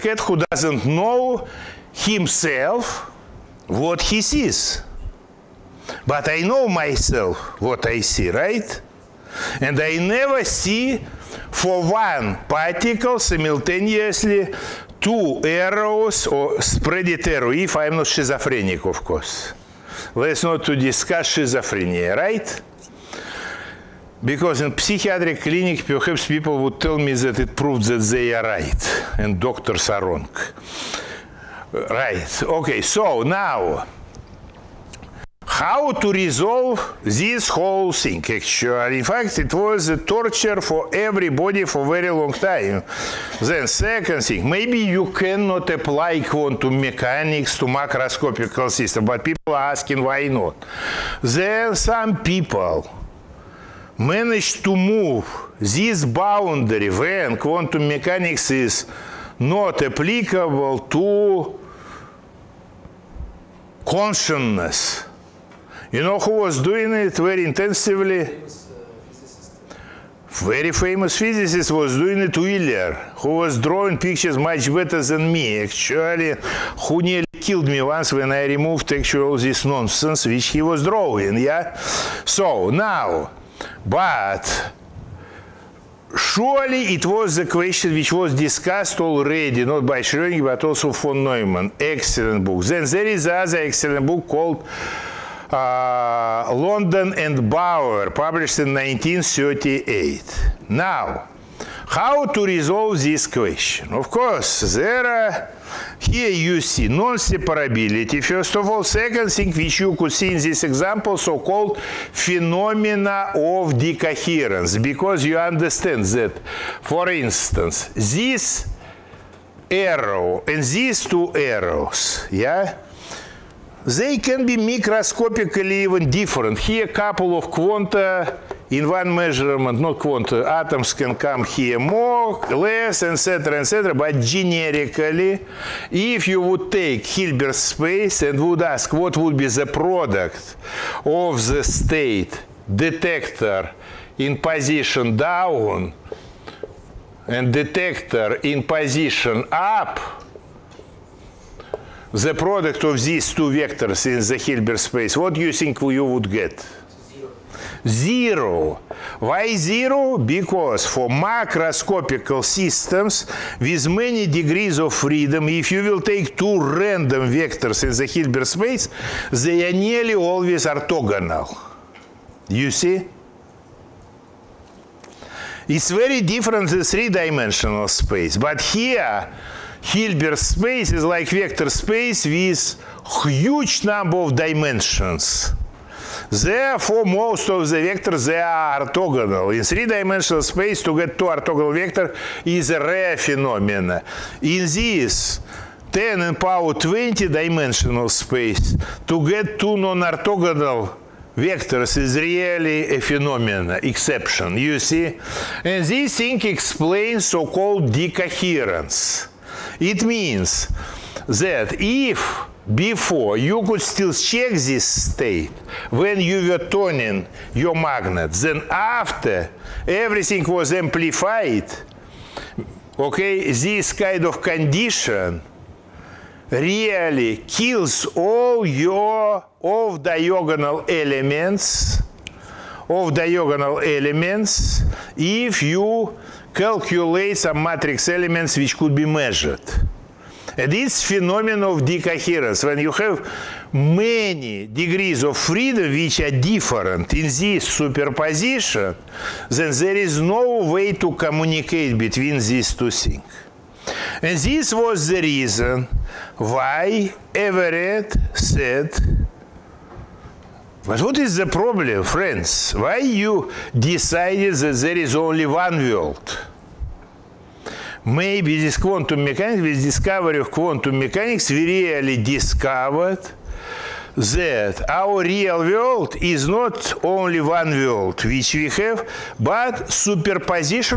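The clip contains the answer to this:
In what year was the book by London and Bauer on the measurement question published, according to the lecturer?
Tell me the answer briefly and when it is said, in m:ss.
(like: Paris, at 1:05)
1938, at 1:38.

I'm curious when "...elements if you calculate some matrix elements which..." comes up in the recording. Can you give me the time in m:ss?
3:53.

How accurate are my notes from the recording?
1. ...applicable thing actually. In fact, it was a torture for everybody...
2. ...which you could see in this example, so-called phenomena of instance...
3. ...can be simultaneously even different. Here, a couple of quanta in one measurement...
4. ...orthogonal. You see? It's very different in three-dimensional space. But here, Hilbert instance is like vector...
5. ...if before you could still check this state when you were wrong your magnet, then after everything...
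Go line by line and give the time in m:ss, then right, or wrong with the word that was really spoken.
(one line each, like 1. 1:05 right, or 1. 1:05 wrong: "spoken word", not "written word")
1. 0:37 wrong: "whole", not "applicable"
2. 1:49 wrong: "decoherence", not "instance"
3. 2:04 wrong: "microscopically", not "simultaneously"
4. 2:50 wrong: "space", not "instance"
5. 3:31 wrong: "turning", not "wrong".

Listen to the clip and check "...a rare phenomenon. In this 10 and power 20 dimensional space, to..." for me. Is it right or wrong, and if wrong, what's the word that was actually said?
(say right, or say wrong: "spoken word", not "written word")
right.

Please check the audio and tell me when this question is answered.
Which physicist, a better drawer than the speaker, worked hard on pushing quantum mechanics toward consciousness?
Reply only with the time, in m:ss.
1:12.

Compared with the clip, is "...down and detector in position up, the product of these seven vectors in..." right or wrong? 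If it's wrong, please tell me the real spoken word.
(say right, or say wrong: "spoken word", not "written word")
wrong: "two", not "seven".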